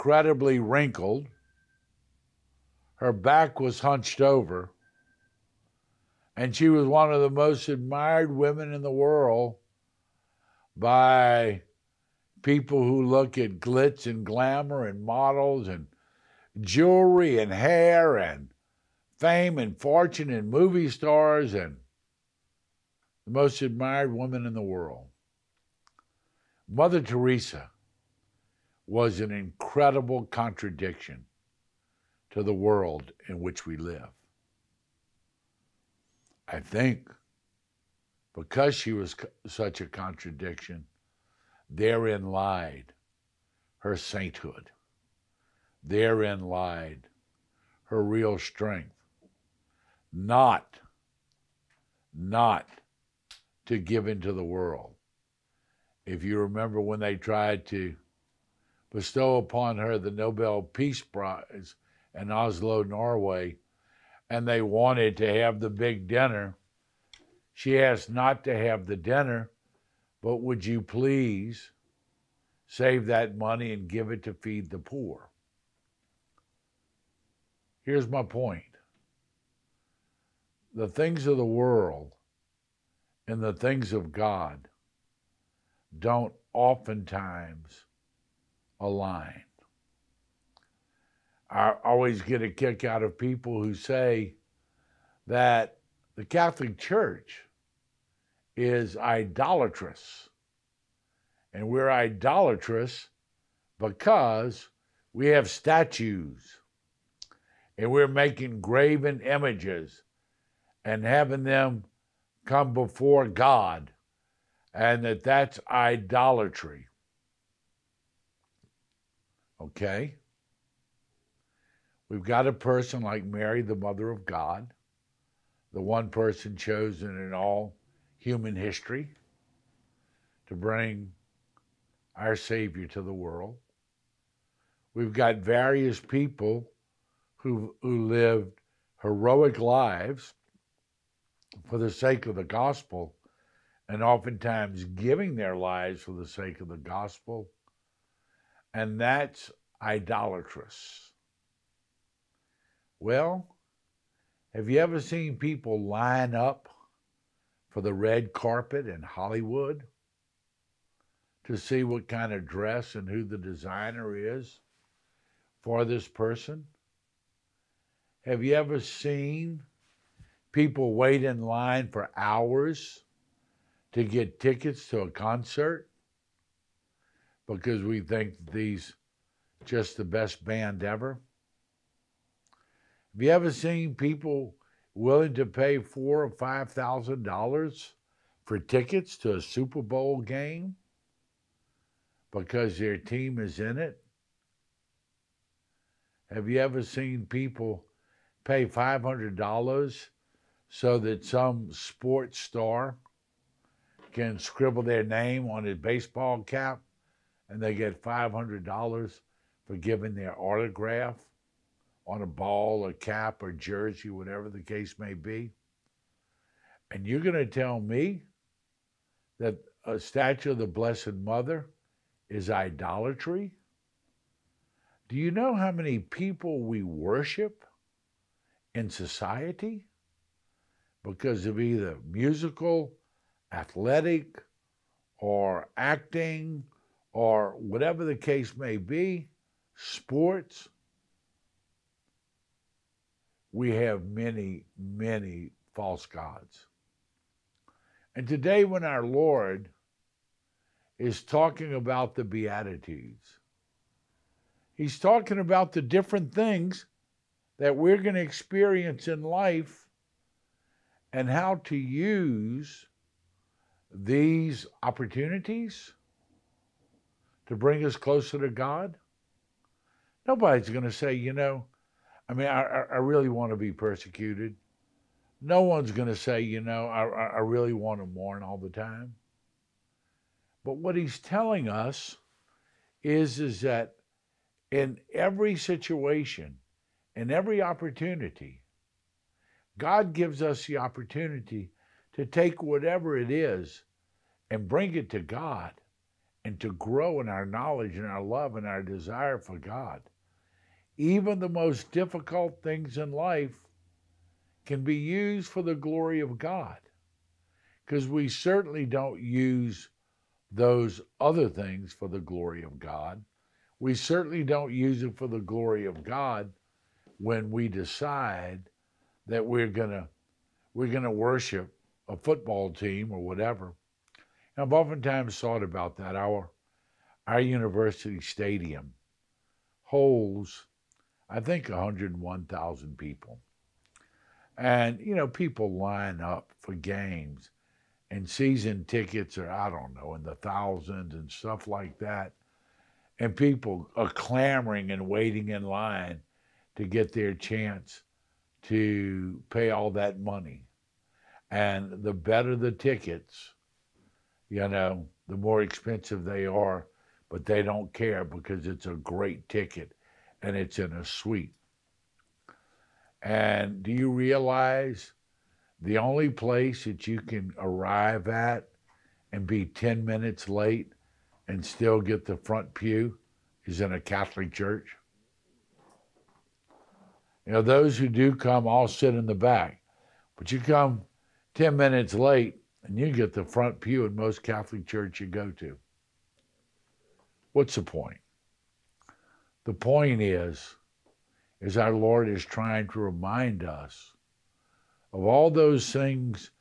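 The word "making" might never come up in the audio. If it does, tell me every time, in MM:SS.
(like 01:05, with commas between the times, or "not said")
01:48.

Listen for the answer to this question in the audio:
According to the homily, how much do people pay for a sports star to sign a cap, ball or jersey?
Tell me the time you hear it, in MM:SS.
03:18.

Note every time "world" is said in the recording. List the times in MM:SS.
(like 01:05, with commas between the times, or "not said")
00:08, 00:24, 00:32, 00:54, 01:21, 02:13.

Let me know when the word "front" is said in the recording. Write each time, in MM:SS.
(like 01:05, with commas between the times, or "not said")
06:12, 06:23.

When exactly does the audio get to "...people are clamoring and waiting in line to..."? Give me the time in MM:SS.
05:43.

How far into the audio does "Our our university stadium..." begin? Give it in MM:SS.
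05:26.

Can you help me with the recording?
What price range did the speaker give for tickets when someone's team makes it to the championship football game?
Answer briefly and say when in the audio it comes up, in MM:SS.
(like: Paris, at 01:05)
4,000 to 5,000 dollars, at 03:05.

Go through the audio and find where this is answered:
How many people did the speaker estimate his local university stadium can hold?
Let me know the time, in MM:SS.
05:31.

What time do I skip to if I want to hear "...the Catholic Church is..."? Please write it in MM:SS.
01:36.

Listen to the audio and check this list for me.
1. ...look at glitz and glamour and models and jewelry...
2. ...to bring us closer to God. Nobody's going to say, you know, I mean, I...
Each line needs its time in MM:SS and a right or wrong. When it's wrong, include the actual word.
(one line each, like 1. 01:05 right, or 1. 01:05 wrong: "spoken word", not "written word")
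1. 00:13 right
2. 04:27 right.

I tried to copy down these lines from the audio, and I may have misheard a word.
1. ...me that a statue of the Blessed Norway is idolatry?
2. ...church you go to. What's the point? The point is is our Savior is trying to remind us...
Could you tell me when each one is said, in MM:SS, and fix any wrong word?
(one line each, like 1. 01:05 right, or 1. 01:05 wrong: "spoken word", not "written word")
1. 03:37 wrong: "Mother", not "Norway"
2. 06:24 wrong: "Lord", not "Savior".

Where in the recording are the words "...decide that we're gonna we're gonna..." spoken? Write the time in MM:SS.
05:17.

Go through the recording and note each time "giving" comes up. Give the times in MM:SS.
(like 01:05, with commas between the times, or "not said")
02:24, 03:29.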